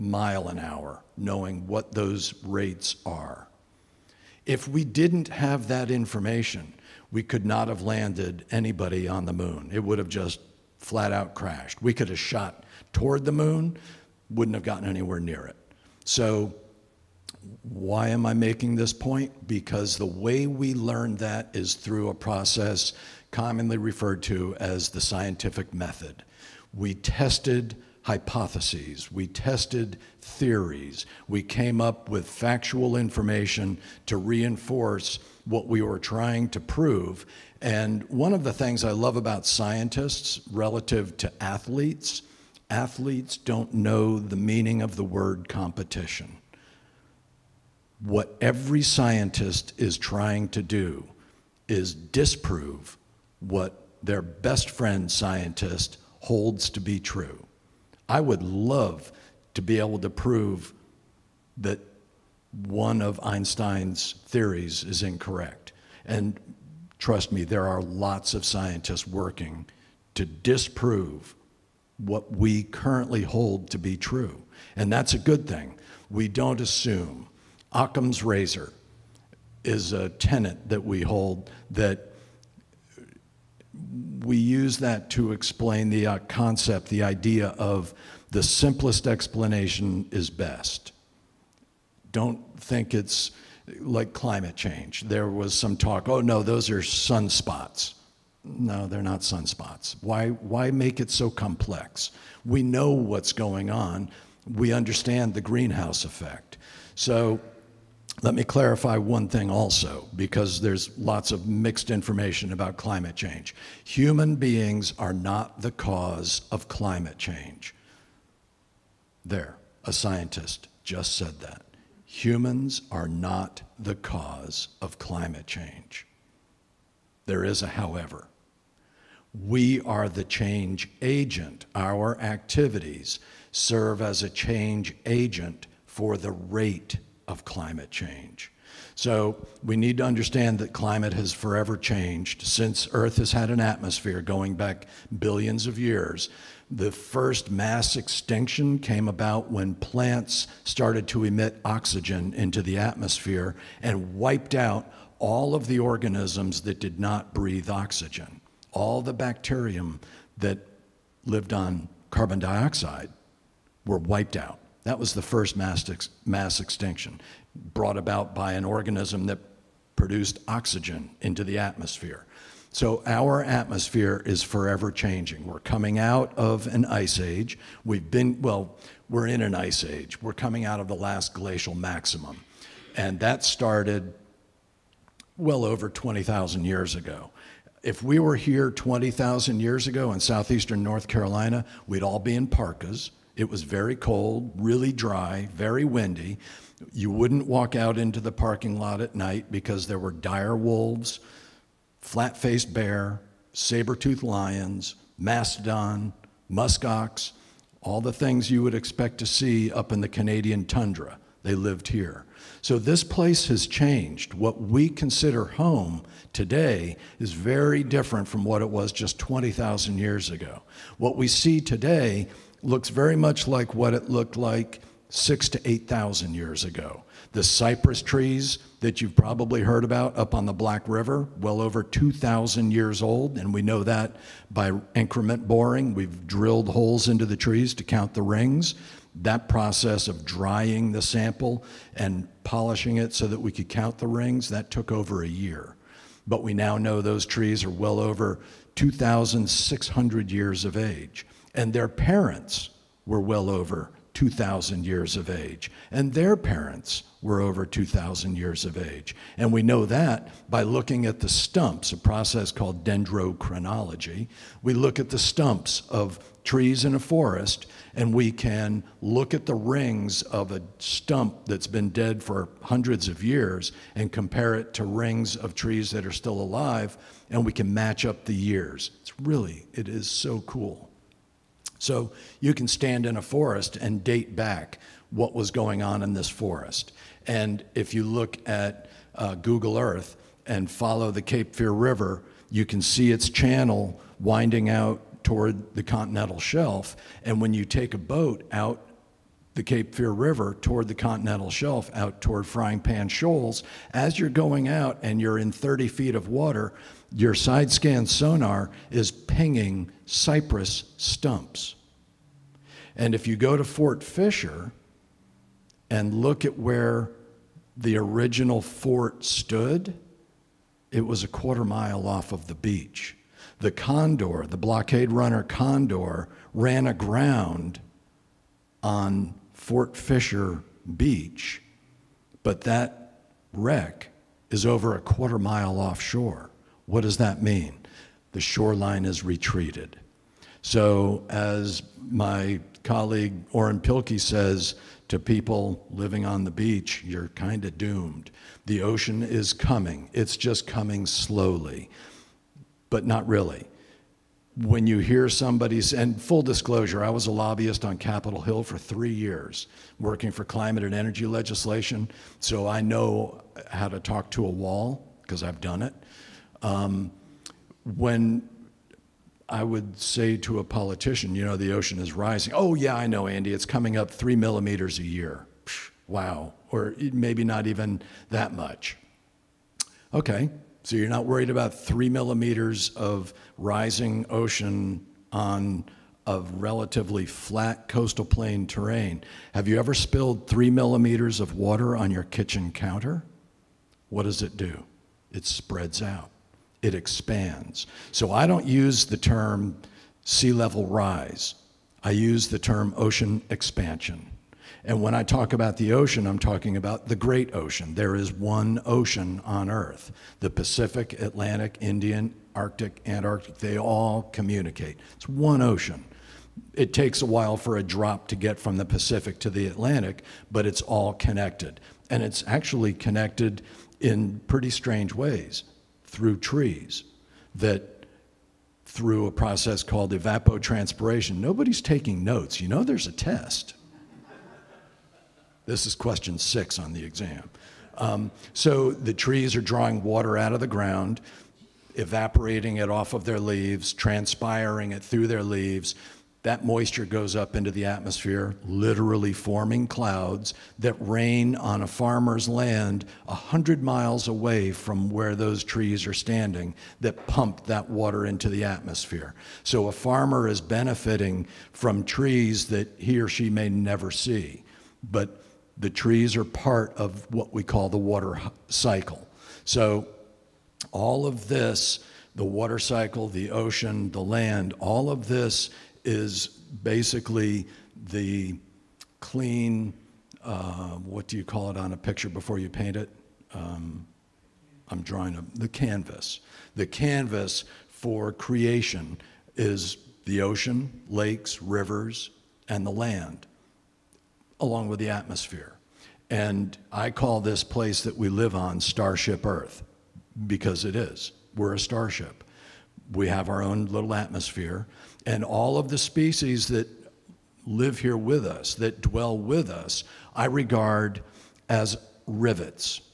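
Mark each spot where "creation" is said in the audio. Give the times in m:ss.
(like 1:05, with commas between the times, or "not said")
8:08.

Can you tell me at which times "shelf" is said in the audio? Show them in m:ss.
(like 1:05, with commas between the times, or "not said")
4:56, 5:01.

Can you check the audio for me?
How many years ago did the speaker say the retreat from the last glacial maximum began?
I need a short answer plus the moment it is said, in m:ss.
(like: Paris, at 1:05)
over 20,000 years, at 3:05.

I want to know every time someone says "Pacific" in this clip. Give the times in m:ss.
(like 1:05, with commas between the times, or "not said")
6:50, 6:58.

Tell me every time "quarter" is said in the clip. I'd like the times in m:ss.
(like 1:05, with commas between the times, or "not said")
5:21, 5:35.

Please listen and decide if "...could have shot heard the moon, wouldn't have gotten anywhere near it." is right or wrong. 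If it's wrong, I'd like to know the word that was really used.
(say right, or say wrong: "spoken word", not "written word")
wrong: "toward", not "heard".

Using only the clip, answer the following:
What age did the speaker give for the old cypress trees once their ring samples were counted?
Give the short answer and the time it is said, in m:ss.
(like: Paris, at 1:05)
over 2,600 years, at 4:07.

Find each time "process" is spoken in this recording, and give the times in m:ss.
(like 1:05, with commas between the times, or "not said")
0:22, 3:59, 4:21, 7:09.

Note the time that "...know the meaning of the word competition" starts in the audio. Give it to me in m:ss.
0:43.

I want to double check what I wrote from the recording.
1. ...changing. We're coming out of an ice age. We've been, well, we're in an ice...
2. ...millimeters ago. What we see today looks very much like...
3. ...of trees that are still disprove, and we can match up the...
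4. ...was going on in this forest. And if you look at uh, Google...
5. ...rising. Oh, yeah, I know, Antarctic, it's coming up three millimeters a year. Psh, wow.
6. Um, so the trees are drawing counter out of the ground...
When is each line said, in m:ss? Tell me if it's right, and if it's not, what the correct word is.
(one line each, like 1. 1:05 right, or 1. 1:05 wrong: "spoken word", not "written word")
1. 2:54 right
2. 3:39 wrong: "years", not "millimeters"
3. 4:35 wrong: "alive", not "disprove"
4. 4:45 right
5. 6:12 wrong: "Andy", not "Antarctic"
6. 7:17 wrong: "water", not "counter".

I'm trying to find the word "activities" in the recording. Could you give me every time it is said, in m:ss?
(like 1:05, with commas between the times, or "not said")
2:12.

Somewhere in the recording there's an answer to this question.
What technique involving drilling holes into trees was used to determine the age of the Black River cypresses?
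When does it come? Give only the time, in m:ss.
3:54.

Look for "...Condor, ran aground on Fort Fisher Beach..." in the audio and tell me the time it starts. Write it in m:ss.
5:25.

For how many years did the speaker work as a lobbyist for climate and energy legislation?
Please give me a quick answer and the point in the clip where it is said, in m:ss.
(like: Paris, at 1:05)
3, at 5:58.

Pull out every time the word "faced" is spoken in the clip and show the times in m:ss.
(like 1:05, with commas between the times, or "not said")
3:22.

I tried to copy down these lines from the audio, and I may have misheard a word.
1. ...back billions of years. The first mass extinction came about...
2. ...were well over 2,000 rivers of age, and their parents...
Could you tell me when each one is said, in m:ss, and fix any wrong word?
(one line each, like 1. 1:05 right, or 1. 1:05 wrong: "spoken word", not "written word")
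1. 2:24 right
2. 4:13 wrong: "years", not "rivers".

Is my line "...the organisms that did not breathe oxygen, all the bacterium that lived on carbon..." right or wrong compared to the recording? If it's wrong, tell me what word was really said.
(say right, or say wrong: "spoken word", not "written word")
right.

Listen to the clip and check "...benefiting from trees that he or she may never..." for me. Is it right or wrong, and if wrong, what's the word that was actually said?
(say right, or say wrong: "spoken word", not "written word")
right.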